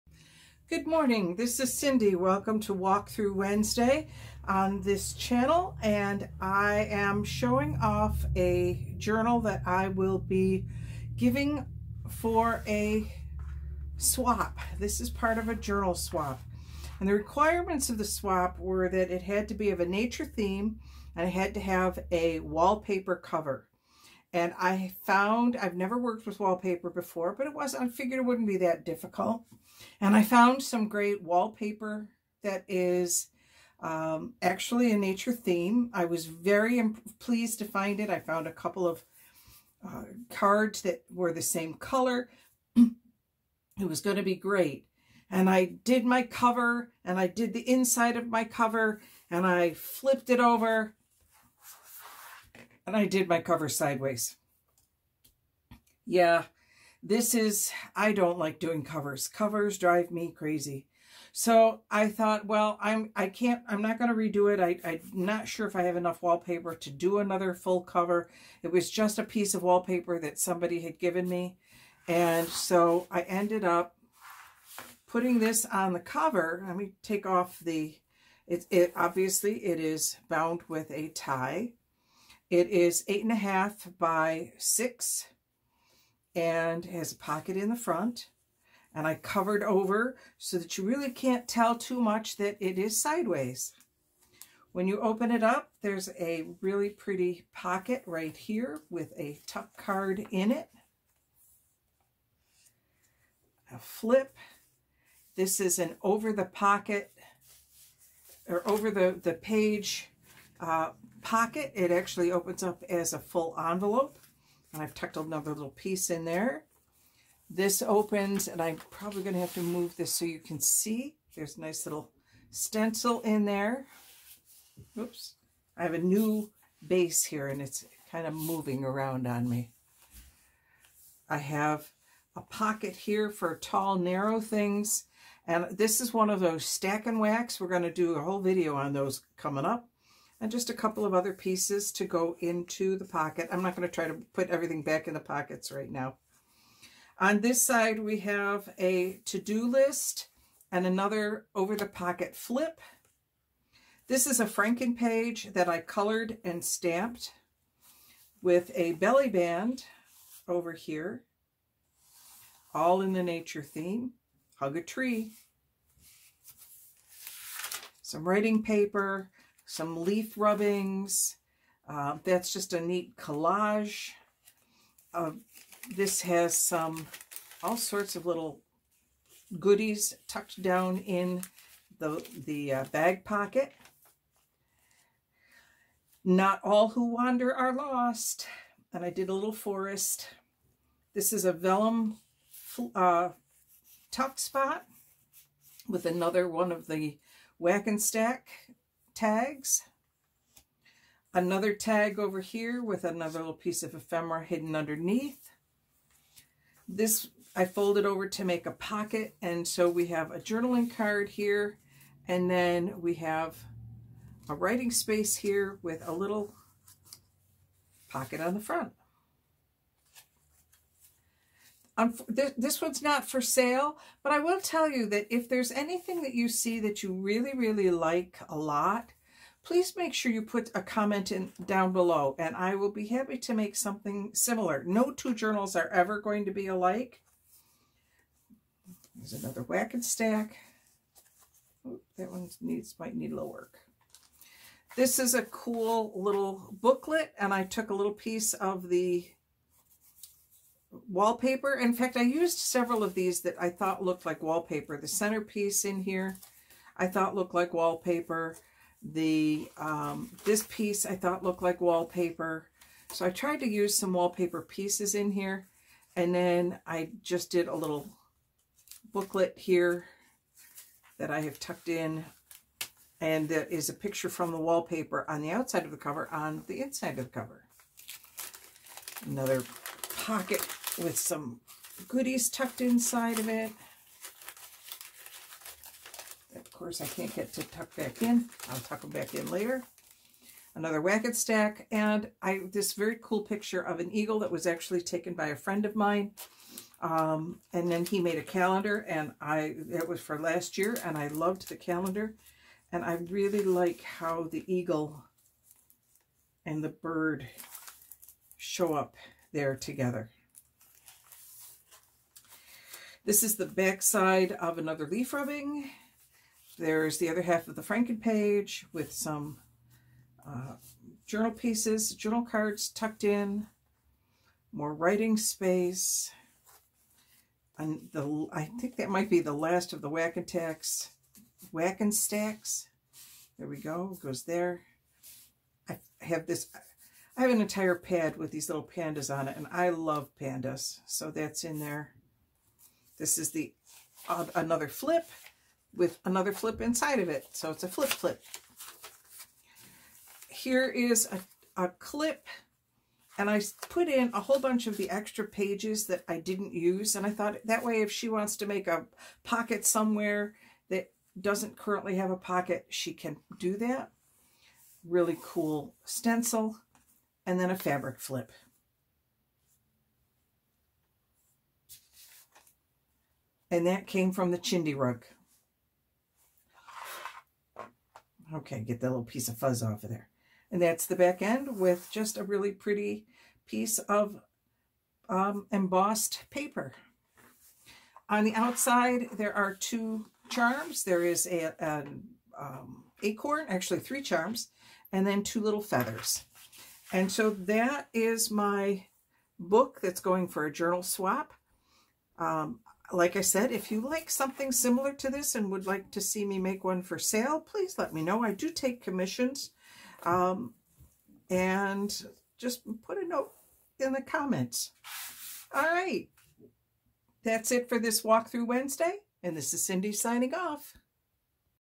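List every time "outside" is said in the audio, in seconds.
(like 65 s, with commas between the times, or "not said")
275 s, 388 s.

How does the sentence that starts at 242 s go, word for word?
that one needs might need a little work.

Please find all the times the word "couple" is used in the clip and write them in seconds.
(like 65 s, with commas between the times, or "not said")
38 s, 140 s.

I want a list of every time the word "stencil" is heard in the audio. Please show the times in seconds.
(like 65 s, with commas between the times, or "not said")
122 s, 366 s.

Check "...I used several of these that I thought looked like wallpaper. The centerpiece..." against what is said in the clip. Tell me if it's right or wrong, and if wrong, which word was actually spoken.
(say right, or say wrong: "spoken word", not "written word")
right.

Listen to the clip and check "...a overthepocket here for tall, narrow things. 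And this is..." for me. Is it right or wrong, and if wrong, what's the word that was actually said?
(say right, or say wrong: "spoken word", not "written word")
wrong: "pocket", not "overthepocket".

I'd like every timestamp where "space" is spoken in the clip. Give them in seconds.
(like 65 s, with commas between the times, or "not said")
214 s, 325 s.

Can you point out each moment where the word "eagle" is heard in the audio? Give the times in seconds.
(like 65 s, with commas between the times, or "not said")
294 s, 304 s.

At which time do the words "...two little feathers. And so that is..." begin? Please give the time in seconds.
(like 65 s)
395 s.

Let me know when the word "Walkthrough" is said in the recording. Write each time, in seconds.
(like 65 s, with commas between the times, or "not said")
2 s, 418 s.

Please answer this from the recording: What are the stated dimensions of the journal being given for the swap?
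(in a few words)
8.5 by 6.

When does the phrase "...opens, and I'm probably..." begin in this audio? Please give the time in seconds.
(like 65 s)
117 s.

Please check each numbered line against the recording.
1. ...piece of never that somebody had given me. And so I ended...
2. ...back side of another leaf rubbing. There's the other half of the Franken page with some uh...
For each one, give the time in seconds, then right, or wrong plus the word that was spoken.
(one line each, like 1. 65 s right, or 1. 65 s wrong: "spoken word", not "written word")
1. 69 s wrong: "wallpaper", not "never"
2. 313 s right.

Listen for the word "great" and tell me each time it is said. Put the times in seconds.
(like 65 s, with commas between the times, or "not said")
30 s, 44 s.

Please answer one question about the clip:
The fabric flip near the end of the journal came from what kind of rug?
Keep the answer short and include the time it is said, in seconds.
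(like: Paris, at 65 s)
Chindi rug, at 374 s.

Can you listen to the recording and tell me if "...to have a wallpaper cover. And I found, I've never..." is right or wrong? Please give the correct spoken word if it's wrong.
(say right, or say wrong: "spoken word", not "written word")
right.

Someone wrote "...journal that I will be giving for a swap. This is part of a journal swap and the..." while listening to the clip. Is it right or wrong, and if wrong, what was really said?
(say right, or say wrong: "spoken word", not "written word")
right.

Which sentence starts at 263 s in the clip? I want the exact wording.
So I tried to use some wallpaper pieces in here.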